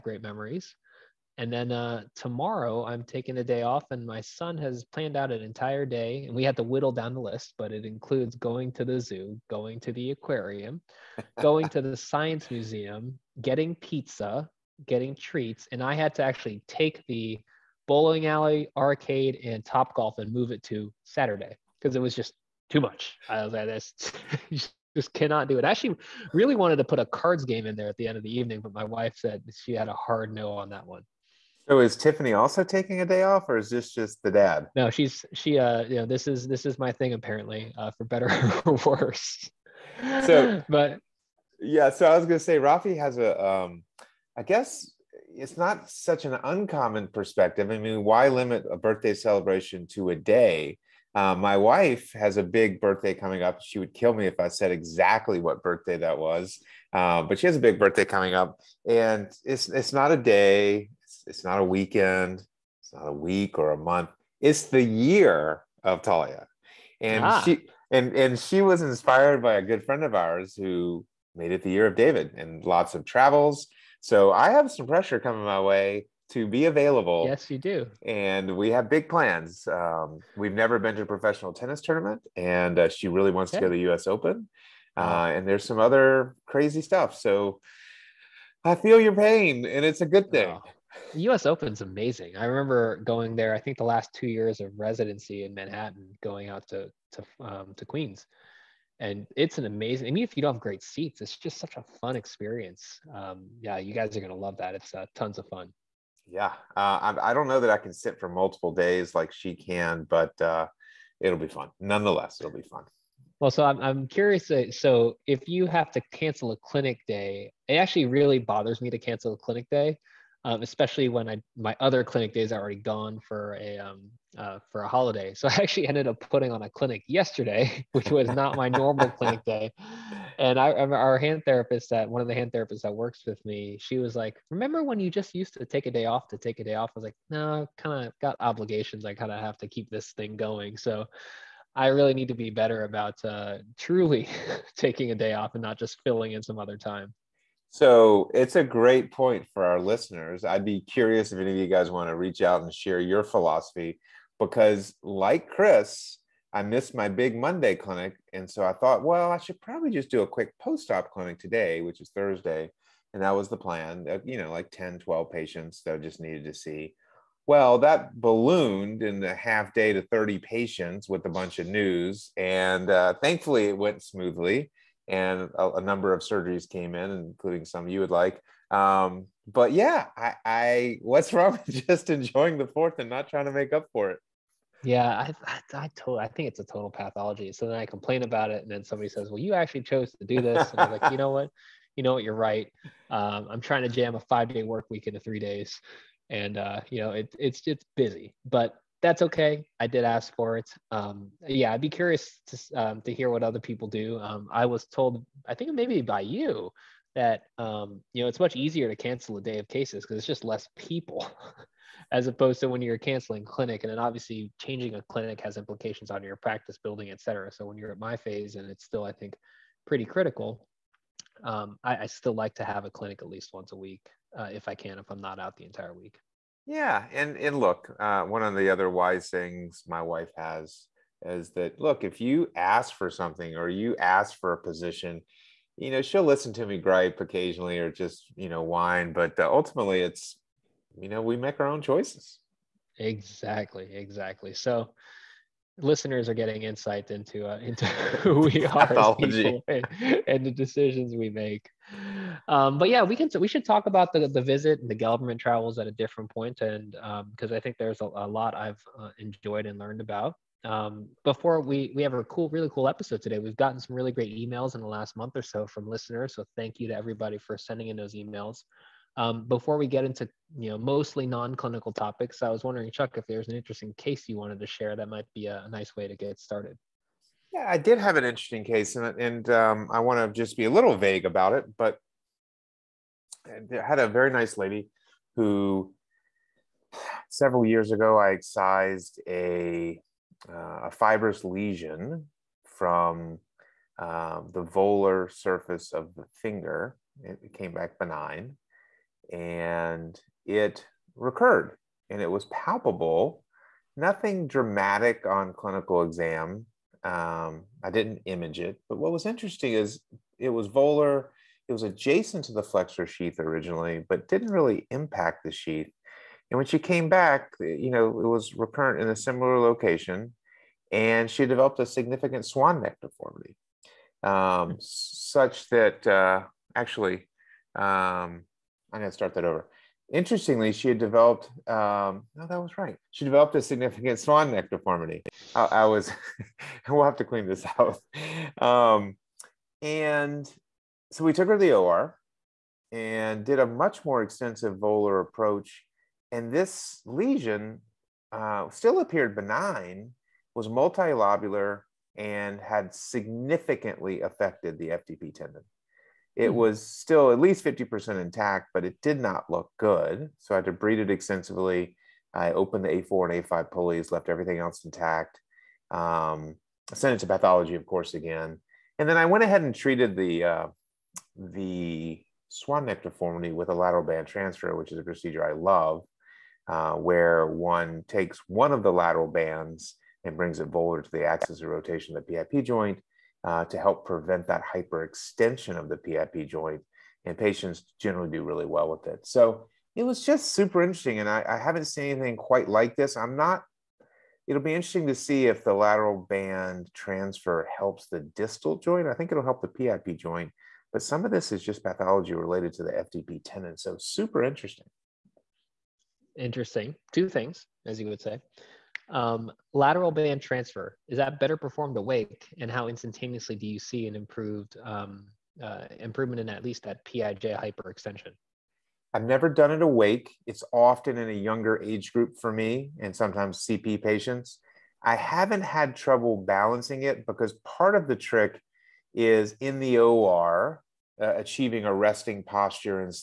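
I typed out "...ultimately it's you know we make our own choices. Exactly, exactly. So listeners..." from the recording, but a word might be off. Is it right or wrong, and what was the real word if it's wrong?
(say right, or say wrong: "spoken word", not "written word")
right.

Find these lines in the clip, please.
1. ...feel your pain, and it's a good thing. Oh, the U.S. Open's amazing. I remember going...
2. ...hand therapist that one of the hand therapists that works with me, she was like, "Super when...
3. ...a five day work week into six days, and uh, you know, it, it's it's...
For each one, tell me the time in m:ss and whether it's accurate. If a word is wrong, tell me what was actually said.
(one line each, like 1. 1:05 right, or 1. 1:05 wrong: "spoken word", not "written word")
1. 1:28 right
2. 2:11 wrong: "Remember", not "Super"
3. 3:14 wrong: "three", not "six".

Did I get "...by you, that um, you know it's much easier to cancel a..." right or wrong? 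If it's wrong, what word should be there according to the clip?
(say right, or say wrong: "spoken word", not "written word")
right.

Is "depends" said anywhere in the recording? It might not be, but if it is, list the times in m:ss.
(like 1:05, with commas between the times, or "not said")
not said.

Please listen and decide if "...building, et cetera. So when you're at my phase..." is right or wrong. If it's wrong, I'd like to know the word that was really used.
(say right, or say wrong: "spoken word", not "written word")
right.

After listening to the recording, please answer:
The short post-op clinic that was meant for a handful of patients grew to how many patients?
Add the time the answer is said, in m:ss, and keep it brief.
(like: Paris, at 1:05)
30, at 2:50.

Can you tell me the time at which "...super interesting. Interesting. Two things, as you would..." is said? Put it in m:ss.
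6:43.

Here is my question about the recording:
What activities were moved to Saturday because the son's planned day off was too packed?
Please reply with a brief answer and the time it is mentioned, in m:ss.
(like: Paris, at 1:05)
bowling alley, arcade, and top golf, at 0:17.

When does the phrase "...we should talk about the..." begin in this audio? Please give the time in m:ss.
4:13.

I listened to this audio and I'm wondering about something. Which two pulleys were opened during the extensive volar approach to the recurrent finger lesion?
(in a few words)
A4 and A5.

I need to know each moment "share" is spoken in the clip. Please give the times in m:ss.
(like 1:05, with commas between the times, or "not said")
2:32, 4:34.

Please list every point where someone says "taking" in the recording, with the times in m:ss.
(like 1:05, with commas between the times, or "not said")
0:03, 0:32, 2:24.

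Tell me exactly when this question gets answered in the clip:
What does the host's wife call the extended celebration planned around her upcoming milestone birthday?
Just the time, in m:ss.
1:04.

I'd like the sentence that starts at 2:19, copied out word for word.
I kind of have to keep this thing going." So.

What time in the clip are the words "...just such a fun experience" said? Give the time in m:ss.
1:41.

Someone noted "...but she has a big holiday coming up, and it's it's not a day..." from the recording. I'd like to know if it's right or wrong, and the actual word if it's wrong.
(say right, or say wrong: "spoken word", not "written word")
wrong: "birthday", not "holiday".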